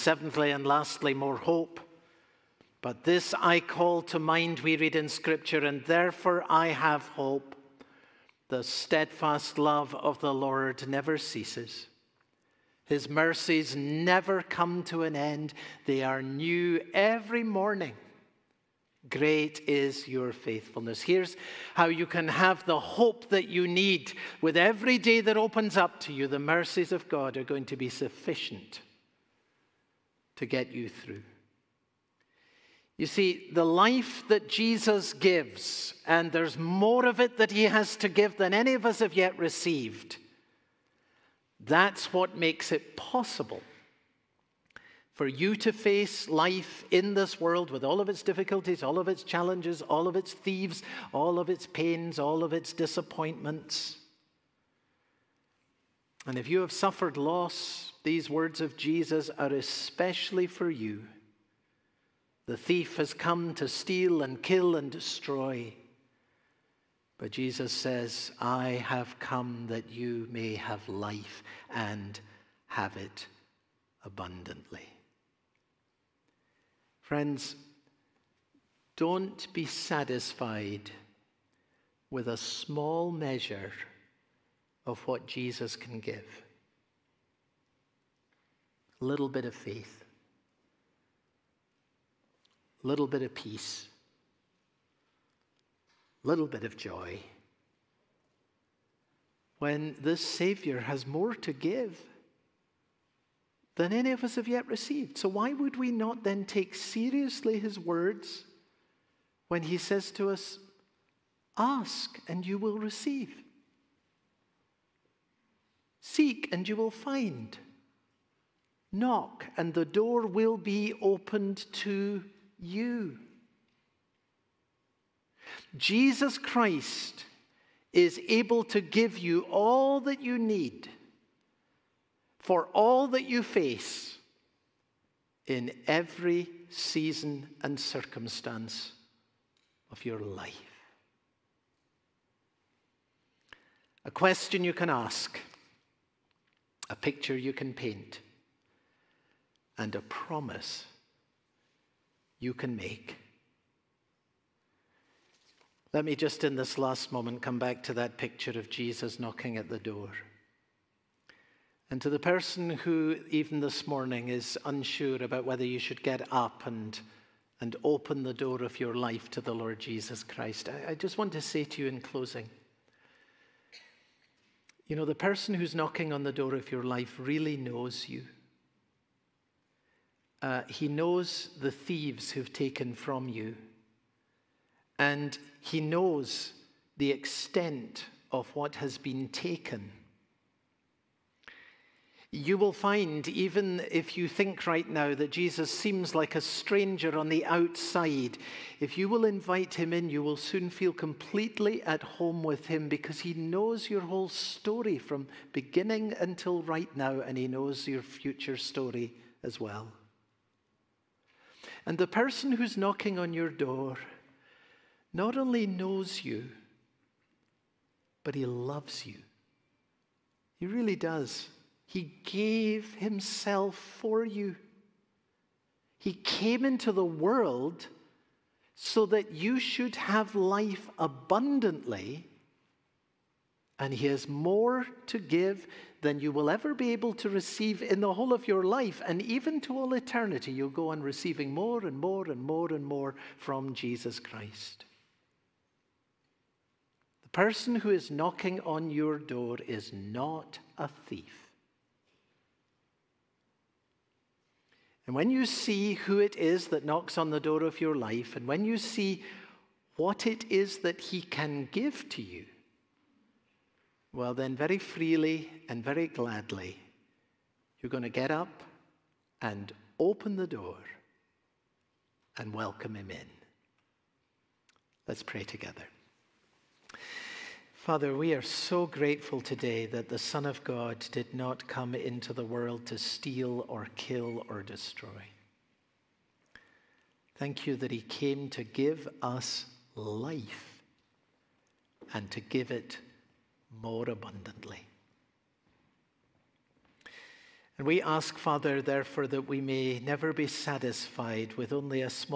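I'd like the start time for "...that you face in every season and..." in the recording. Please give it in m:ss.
2:13.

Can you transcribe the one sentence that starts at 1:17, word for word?
Friends, don't be satisfied with a small measure of what Jesus can give.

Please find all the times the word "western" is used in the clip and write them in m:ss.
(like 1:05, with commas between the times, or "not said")
not said.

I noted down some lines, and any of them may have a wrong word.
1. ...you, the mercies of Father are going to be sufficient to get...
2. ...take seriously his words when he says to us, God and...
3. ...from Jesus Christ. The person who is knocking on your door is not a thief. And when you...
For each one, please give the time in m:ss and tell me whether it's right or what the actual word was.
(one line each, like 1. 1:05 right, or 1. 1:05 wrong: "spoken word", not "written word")
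1. 0:26 wrong: "God", not "Father"
2. 1:46 wrong: "Ask", not "God"
3. 4:03 right.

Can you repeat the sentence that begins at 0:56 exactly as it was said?
And if you have suffered loss, these words of Jesus are especially for you.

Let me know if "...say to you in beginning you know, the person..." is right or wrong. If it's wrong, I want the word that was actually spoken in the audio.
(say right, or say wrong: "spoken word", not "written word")
wrong: "closing", not "beginning".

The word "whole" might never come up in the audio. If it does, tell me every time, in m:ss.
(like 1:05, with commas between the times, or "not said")
3:23, 3:58.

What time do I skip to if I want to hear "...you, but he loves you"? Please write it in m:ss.
3:36.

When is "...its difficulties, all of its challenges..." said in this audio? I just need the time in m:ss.
0:48.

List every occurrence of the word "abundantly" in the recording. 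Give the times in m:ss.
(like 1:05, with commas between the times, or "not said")
1:14, 3:50, 4:54.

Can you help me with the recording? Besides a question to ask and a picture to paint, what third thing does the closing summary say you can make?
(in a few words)
a promise.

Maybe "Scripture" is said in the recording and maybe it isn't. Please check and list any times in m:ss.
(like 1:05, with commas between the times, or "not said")
0:05.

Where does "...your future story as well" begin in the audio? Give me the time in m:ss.
3:27.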